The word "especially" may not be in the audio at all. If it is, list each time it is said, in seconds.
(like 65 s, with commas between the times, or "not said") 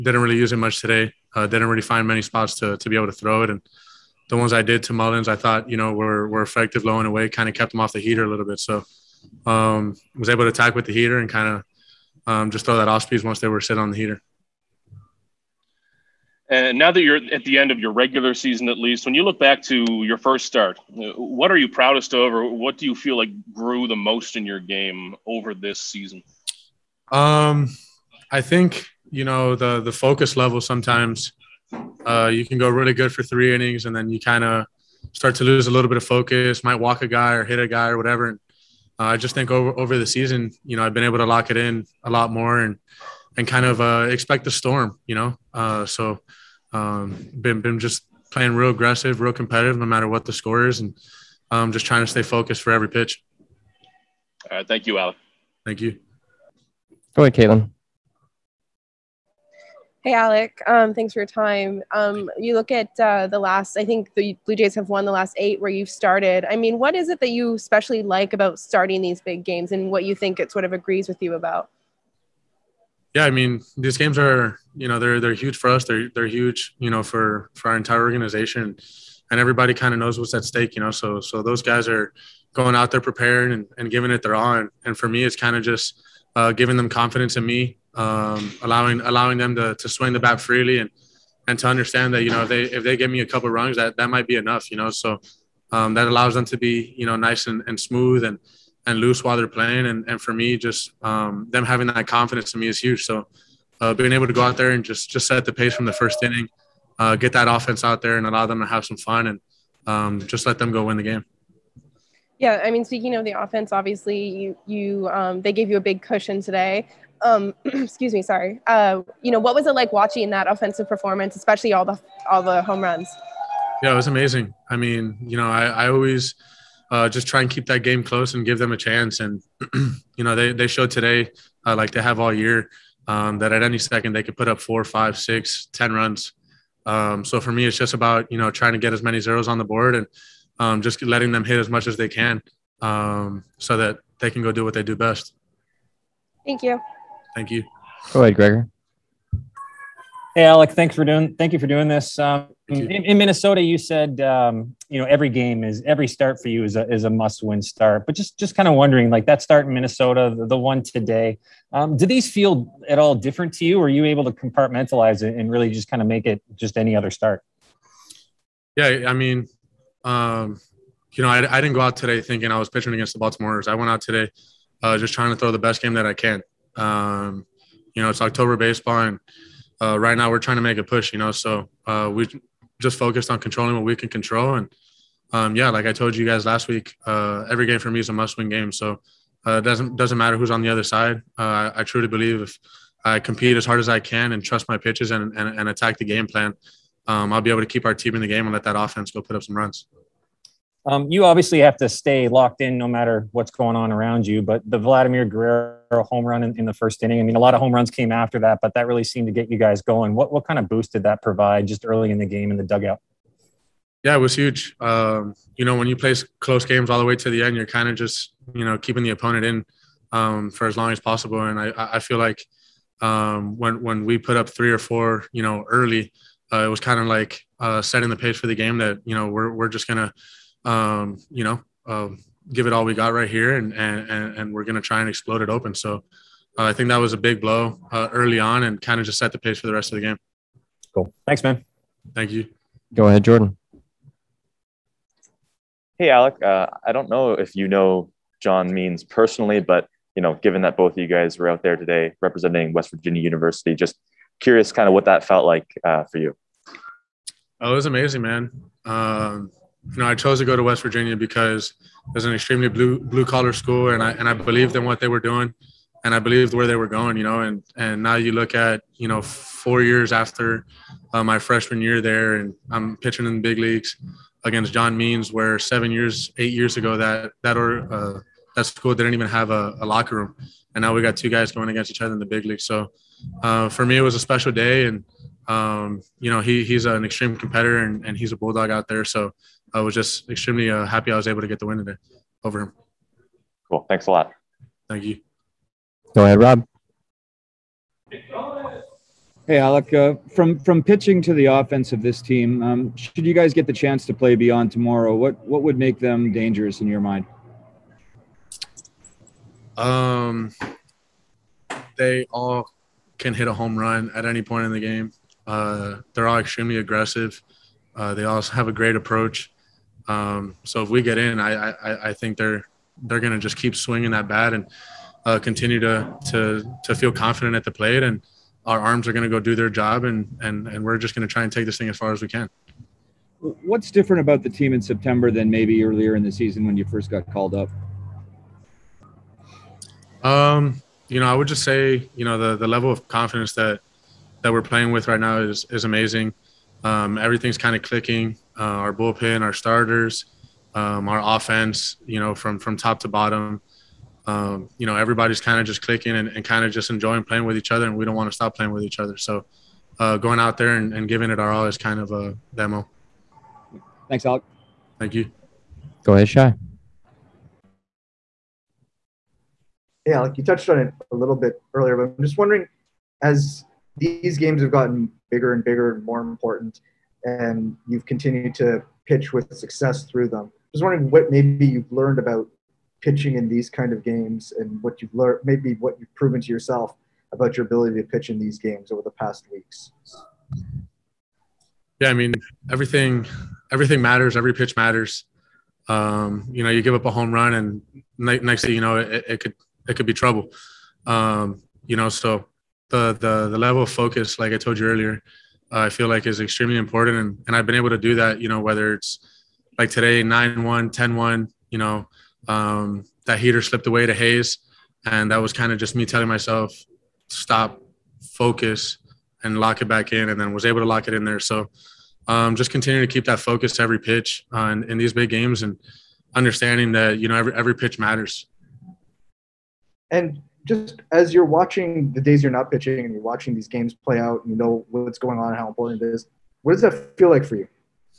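67 s, 121 s.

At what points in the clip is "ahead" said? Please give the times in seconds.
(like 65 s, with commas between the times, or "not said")
57 s, 148 s, 243 s, 296 s, 366 s.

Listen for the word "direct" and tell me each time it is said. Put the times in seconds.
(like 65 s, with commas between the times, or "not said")
not said.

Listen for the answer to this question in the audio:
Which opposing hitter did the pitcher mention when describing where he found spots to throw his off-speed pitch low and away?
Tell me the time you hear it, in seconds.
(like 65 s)
4 s.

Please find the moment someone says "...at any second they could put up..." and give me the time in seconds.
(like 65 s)
133 s.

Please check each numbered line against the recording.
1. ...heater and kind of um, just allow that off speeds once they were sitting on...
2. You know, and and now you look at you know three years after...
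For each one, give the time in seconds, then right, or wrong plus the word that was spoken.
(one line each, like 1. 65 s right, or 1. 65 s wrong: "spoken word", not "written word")
1. 10 s wrong: "throw", not "allow"
2. 267 s wrong: "four", not "three".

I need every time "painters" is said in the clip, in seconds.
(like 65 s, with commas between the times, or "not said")
not said.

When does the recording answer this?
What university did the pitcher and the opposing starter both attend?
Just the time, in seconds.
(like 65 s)
252 s.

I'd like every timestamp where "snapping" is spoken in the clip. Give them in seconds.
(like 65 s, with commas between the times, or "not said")
not said.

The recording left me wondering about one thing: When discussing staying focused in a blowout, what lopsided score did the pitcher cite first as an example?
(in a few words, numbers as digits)
9-1.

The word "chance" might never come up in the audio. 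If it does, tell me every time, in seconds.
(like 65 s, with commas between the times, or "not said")
128 s, 303 s.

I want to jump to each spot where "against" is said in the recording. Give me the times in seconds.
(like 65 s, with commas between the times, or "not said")
172 s, 274 s, 281 s.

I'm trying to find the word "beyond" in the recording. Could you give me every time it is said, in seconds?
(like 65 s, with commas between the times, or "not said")
304 s.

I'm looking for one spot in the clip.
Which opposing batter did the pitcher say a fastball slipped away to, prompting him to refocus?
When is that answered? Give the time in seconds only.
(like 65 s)
414 s.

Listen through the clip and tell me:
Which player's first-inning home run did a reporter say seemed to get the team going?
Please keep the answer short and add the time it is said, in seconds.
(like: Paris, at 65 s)
Vladimir Guerrero, at 204 s.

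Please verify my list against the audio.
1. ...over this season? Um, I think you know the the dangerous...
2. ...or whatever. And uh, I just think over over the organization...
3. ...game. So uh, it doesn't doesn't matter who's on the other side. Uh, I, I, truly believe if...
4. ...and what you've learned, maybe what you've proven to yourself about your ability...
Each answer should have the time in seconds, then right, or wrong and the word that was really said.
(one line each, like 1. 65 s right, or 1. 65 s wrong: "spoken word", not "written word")
1. 25 s wrong: "focus", not "dangerous"
2. 37 s wrong: "season", not "organization"
3. 188 s right
4. 384 s right.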